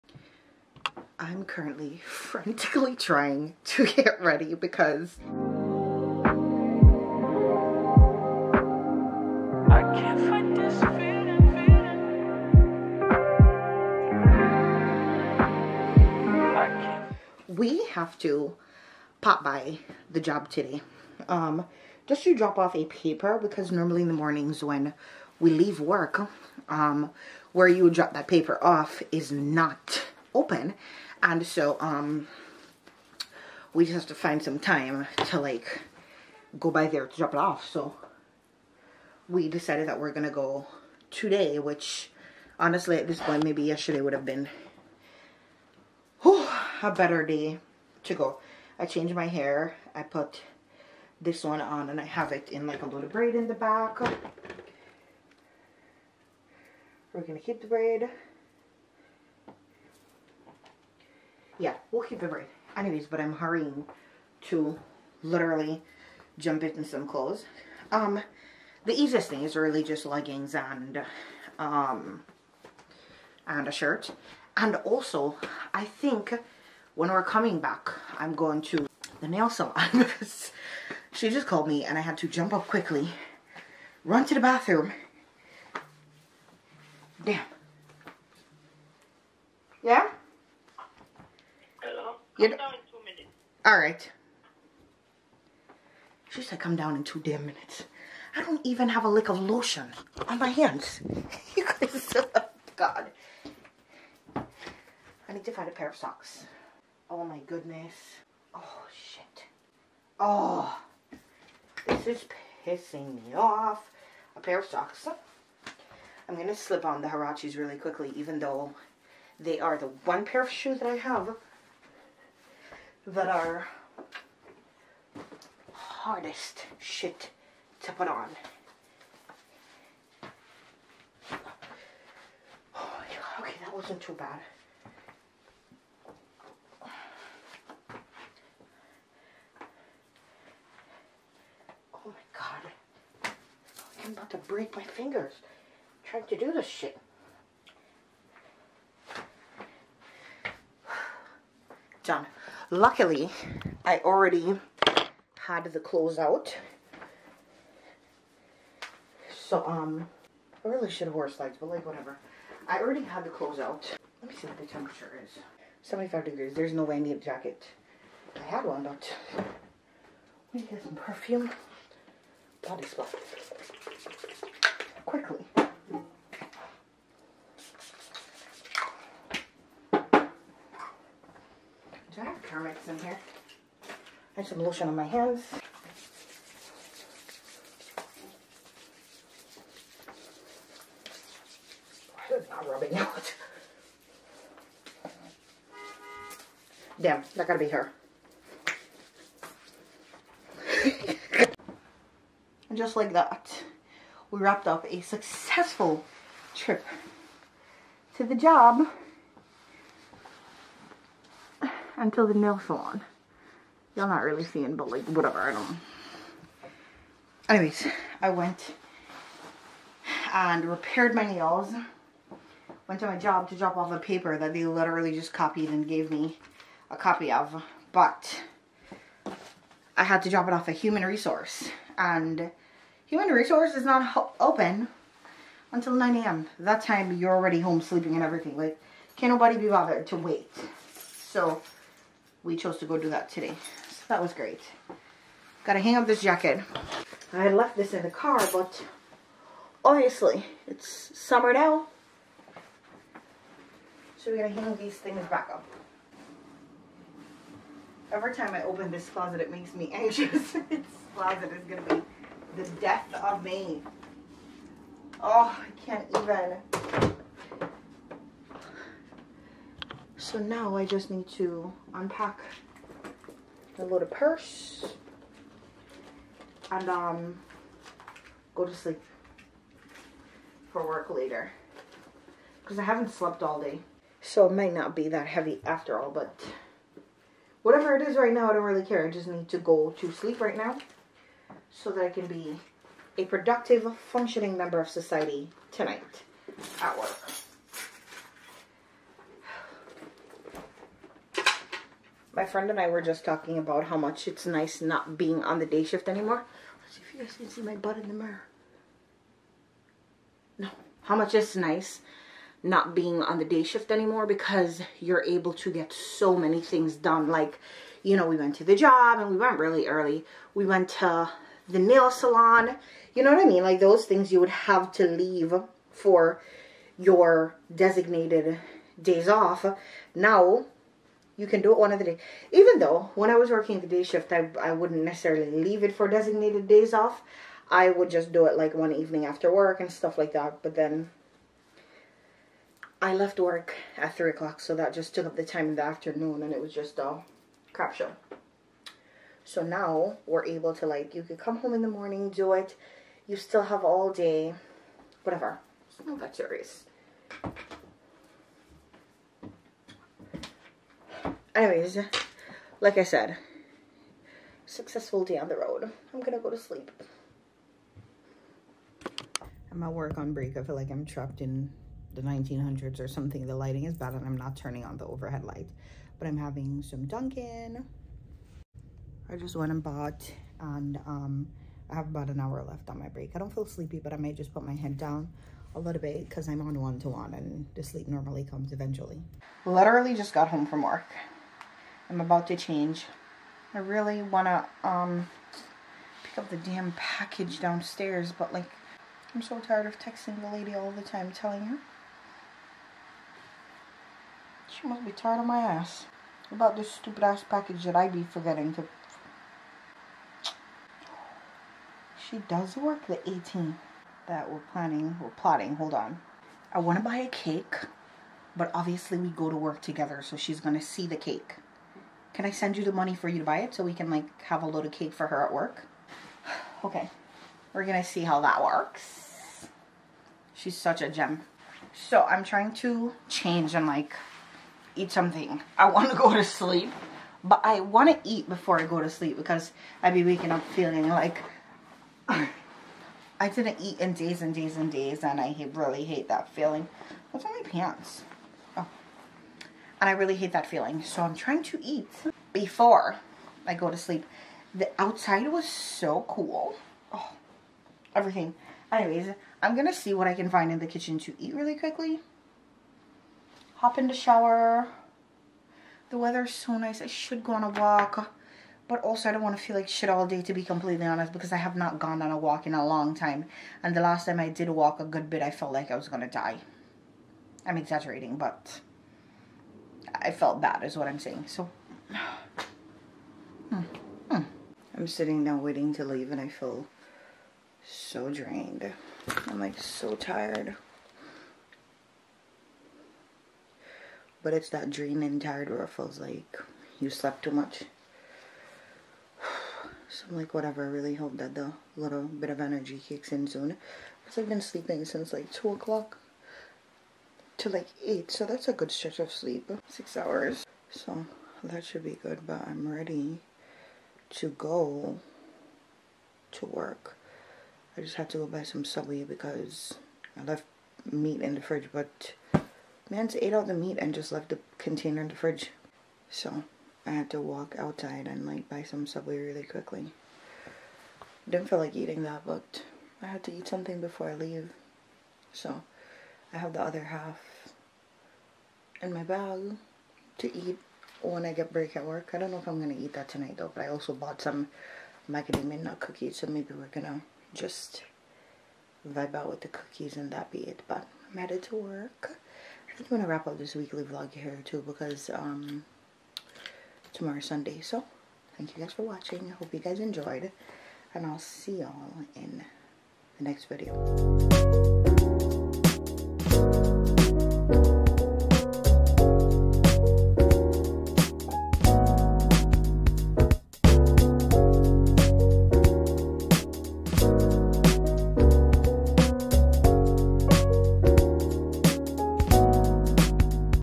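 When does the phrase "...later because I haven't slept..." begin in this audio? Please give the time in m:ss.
4:41.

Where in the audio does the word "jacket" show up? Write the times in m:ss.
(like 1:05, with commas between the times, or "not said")
2:47, 4:06.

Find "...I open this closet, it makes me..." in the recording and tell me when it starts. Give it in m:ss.
4:18.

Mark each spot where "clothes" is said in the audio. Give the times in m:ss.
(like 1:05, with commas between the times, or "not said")
1:07, 2:35, 2:43.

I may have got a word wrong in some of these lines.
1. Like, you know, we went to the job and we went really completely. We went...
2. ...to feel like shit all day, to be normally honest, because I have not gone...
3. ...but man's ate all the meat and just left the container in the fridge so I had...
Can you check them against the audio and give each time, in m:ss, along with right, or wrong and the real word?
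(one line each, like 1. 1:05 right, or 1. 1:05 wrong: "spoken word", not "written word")
1. 5:17 wrong: "early", not "completely"
2. 7:49 wrong: "completely", not "normally"
3. 8:41 right.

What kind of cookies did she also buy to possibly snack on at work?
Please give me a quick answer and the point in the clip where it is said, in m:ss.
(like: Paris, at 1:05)
macadamia nut, at 9:05.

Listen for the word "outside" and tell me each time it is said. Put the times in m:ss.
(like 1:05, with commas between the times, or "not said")
7:34, 8:47.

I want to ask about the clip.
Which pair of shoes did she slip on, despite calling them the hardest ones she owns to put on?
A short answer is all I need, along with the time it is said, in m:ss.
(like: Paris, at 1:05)
Huaraches, at 1:57.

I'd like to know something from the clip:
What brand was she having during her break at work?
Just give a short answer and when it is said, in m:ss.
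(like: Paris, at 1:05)
Dunkin', at 6:17.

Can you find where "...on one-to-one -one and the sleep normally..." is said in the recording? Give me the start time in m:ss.
6:26.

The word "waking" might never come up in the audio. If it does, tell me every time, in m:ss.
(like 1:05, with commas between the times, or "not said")
7:20.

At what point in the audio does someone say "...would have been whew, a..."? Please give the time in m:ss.
0:44.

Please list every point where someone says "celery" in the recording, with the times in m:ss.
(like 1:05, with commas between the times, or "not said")
not said.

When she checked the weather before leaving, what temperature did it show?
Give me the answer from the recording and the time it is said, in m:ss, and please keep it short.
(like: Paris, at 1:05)
75 degrees, at 2:45.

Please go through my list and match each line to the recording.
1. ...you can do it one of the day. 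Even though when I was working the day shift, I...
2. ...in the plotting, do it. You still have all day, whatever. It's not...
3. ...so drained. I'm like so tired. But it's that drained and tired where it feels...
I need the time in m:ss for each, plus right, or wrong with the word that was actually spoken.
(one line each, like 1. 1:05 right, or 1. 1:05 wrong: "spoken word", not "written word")
1. 5:31 right
2. 5:51 wrong: "morning", not "plotting"
3. 8:07 right.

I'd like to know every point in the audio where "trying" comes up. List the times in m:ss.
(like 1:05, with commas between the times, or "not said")
0:02, 2:26, 7:12, 7:31.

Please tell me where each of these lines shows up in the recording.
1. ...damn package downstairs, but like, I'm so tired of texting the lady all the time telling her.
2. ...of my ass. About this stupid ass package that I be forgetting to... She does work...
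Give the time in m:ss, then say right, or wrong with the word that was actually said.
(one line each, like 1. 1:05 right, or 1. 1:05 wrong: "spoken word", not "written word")
1. 6:36 right
2. 6:45 right.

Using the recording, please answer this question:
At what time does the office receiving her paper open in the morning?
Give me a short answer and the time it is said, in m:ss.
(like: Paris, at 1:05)
9 a.m., at 3:55.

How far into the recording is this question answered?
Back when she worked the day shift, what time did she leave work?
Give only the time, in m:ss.
5:44.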